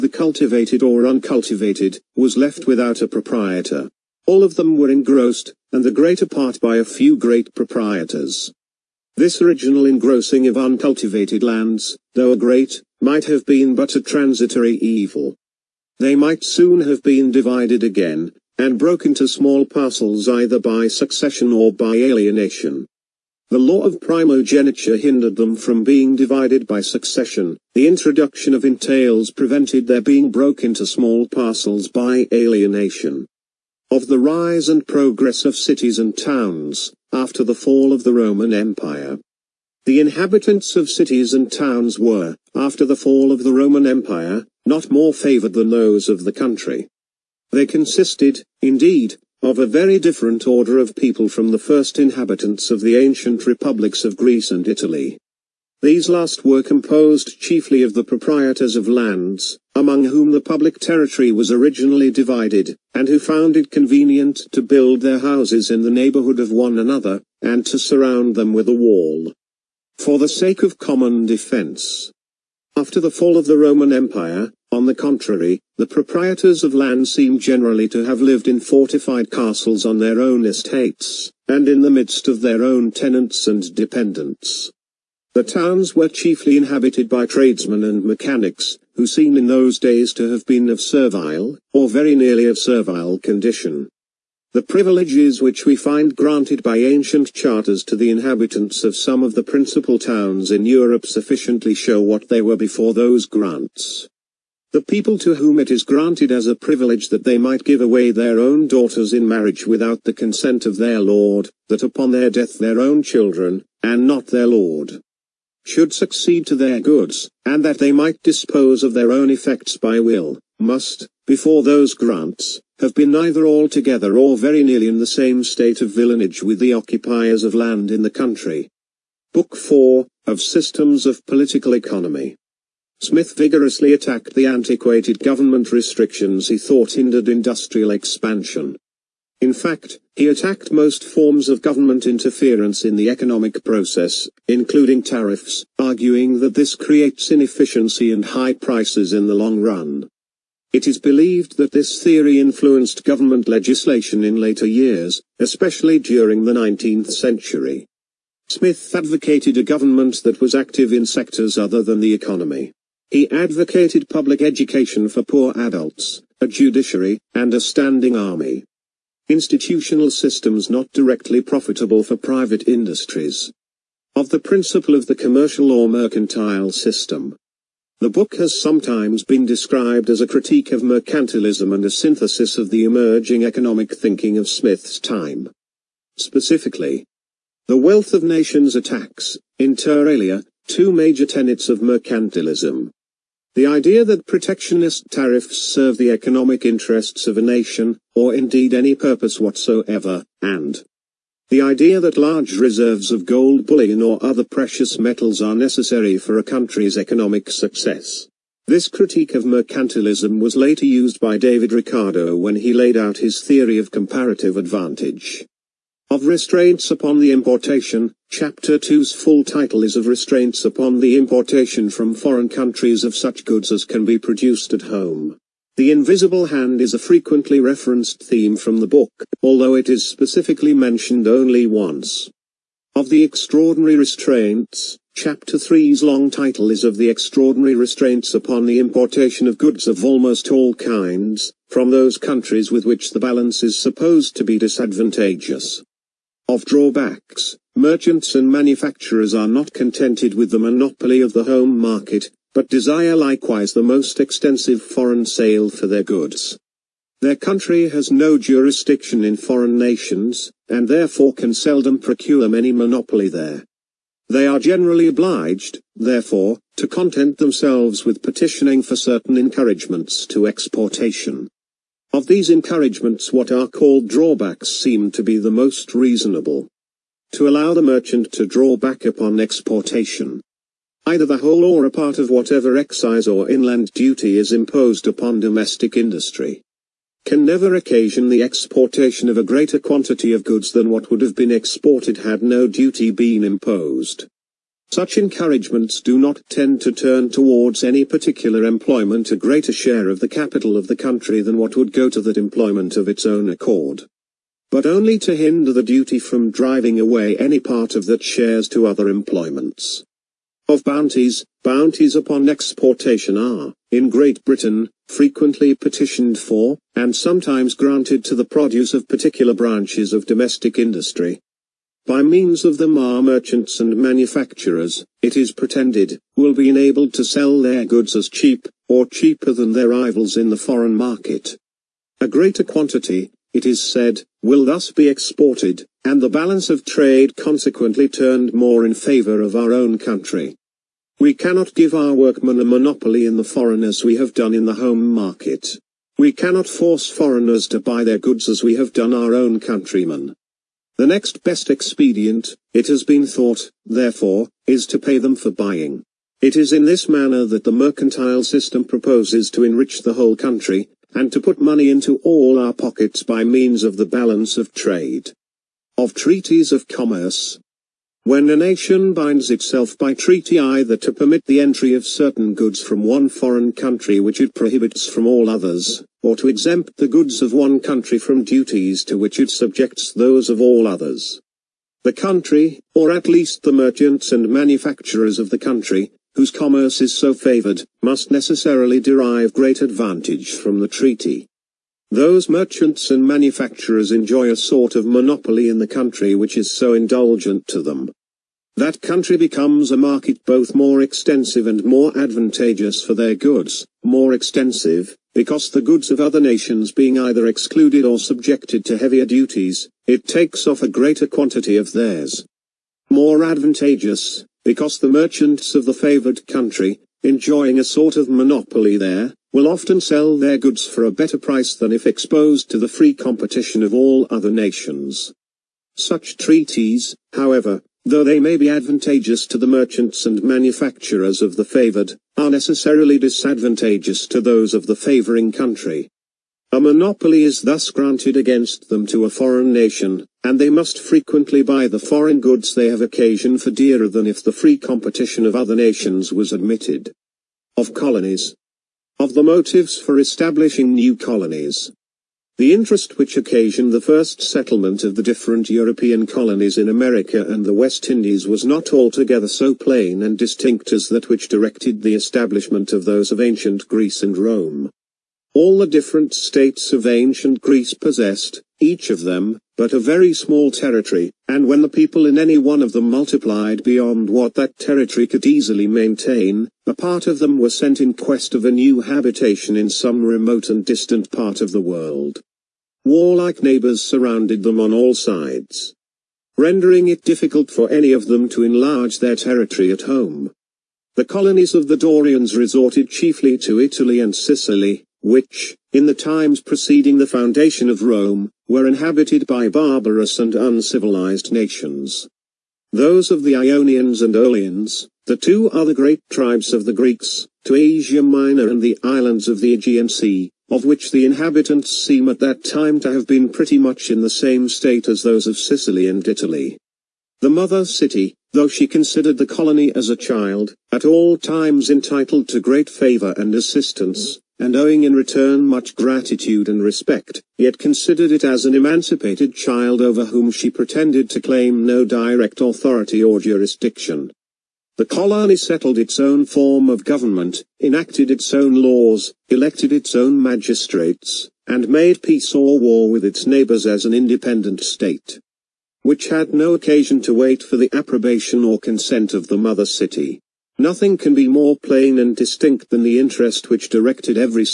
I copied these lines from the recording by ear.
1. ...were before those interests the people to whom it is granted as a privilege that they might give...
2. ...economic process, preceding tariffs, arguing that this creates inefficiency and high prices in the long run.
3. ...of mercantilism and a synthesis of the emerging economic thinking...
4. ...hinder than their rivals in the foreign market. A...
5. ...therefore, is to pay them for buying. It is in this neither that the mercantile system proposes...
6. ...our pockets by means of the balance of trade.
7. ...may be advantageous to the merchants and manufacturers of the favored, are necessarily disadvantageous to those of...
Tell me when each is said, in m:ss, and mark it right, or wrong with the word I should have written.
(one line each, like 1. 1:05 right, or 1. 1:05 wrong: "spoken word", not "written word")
1. 1:42 wrong: "grants", not "interests"
2. 2:23 wrong: "including", not "preceding"
3. 3:00 right
4. 5:29 wrong: "cheaper", not "hinder"
5. 5:53 wrong: "manner", not "neither"
6. 6:02 right
7. 7:08 right.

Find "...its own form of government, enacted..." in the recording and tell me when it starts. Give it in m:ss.
8:55.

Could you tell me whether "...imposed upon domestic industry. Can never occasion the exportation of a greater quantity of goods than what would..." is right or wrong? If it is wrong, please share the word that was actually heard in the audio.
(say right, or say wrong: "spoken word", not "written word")
right.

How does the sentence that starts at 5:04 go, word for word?
But only to hinder the duty from driving away any part of that shares to other employments.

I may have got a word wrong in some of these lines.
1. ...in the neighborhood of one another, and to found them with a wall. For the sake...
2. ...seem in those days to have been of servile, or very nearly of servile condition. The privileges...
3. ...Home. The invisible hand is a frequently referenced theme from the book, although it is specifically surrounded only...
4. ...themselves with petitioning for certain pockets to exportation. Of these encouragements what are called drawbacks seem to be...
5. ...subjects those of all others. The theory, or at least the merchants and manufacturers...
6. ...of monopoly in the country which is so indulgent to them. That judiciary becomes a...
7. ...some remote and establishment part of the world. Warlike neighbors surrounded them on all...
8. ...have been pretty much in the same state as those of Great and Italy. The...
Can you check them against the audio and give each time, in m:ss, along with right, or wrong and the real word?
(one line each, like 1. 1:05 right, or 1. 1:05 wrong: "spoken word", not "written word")
1. 1:05 wrong: "surround", not "found"
2. 1:29 right
3. 3:44 wrong: "mentioned", not "surrounded"
4. 4:27 wrong: "encouragements", not "pockets"
5. 6:19 wrong: "country", not "theory"
6. 6:34 wrong: "country", not "judiciary"
7. 7:59 wrong: "distant", not "establishment"
8. 8:33 wrong: "Sicily", not "Great".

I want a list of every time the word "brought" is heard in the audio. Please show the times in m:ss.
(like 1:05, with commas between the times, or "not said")
not said.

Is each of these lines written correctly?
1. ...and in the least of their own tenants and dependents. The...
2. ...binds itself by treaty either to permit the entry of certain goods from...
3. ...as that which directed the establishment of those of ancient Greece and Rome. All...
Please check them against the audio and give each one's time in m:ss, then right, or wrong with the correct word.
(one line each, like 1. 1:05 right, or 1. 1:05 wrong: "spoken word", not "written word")
1. 1:21 wrong: "midst", not "least"
2. 6:09 right
3. 7:40 right.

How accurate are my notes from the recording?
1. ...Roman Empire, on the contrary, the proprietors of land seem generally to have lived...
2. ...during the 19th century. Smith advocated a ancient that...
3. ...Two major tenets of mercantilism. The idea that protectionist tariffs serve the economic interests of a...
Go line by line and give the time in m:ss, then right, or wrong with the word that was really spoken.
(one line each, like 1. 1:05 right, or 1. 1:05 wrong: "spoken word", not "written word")
1. 1:13 right
2. 2:35 wrong: "government", not "ancient"
3. 3:10 right.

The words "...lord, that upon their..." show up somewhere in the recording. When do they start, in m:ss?
1:50.